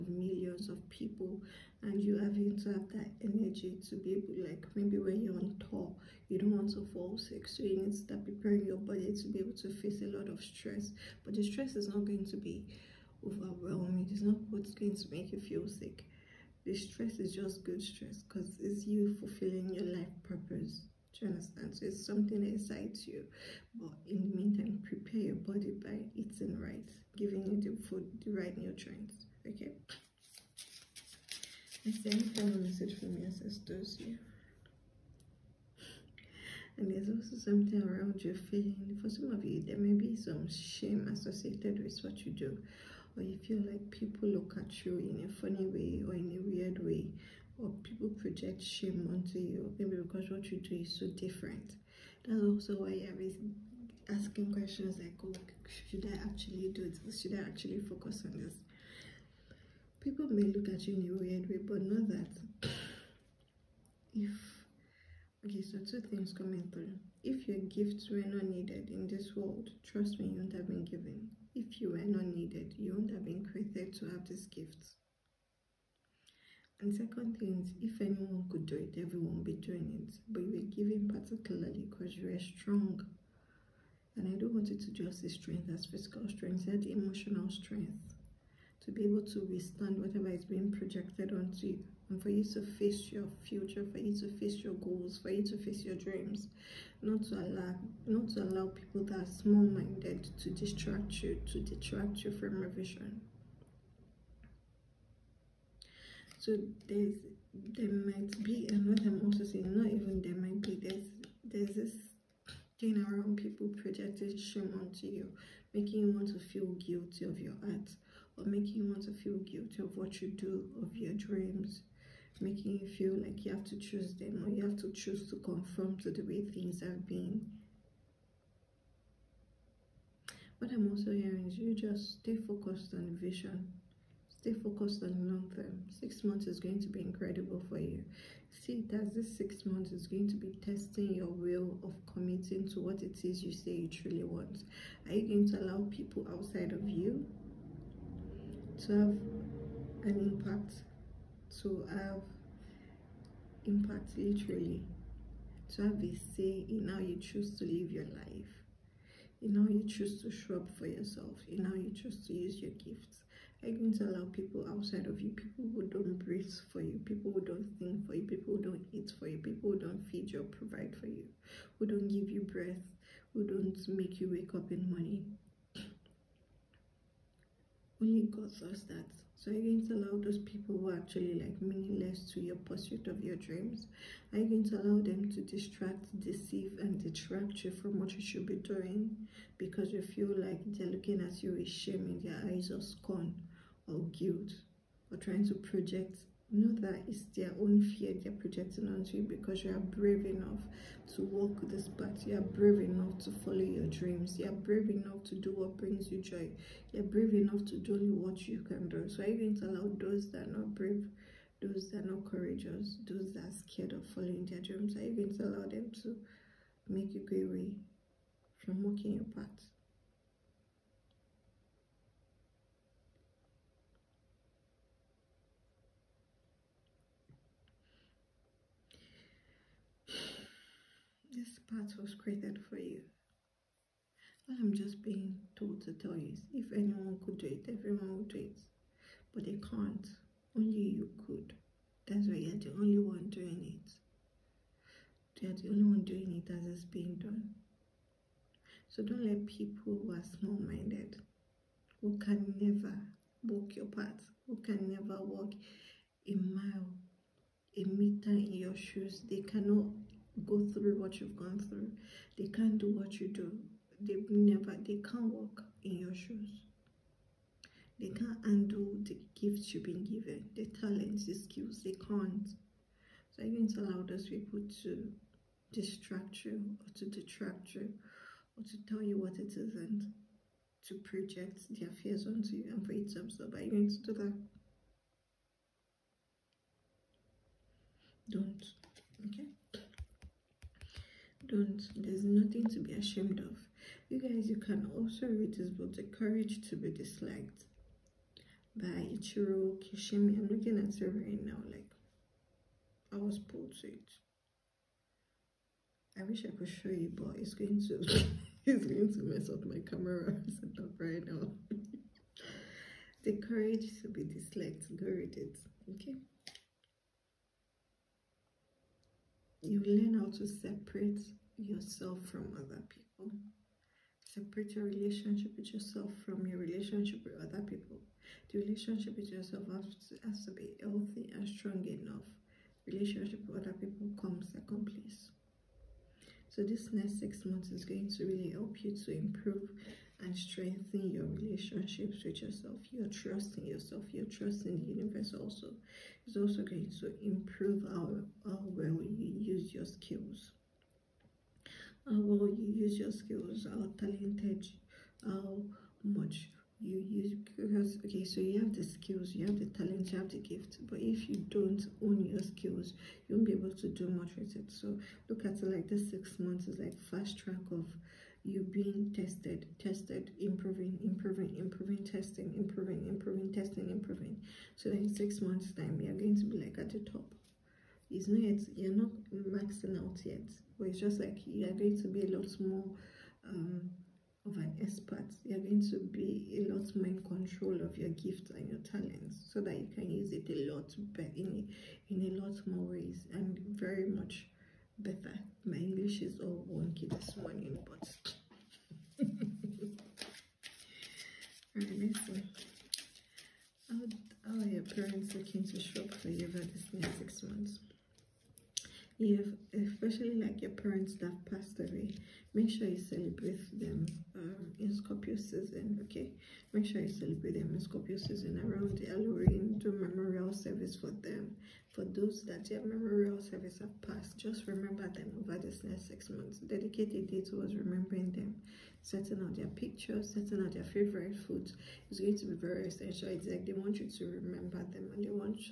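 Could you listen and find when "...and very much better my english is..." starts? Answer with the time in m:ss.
6:33.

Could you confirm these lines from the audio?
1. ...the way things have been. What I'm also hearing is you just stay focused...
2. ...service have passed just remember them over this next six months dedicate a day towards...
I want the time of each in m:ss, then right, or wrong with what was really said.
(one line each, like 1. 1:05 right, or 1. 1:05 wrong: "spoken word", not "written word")
1. 2:06 right
2. 7:03 right.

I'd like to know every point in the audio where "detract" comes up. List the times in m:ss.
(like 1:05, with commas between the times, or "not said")
1:41, 3:07, 4:37.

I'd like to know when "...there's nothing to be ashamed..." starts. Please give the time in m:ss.
4:52.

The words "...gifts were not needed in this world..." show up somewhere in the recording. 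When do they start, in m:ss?
1:07.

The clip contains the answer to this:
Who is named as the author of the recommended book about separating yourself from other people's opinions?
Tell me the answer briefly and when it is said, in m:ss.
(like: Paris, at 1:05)
Ichiro Kishimi, at 4:59.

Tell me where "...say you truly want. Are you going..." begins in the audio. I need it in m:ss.
2:23.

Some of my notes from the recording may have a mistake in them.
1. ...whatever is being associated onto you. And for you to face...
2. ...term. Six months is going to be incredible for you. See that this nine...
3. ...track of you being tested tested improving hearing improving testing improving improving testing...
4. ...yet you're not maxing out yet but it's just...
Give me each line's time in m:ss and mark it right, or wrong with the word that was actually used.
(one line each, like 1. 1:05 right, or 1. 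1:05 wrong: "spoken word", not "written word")
1. 1:29 wrong: "projected", not "associated"
2. 2:15 wrong: "six", not "nine"
3. 6:07 wrong: "improving", not "hearing"
4. 6:18 right.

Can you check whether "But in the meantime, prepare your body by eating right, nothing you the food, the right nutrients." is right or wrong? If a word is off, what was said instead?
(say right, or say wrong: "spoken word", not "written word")
wrong: "giving", not "nothing".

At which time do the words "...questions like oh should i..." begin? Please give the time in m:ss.
0:54.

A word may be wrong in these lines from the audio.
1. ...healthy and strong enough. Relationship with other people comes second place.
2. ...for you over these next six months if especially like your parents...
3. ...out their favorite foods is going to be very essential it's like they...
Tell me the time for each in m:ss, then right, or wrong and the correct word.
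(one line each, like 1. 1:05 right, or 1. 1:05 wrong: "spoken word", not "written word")
1. 5:30 right
2. 6:46 right
3. 7:10 right.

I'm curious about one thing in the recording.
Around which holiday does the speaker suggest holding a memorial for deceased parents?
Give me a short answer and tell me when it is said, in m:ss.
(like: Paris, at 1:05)
Halloween, at 6:59.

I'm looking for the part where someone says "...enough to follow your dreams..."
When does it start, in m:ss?
3:22.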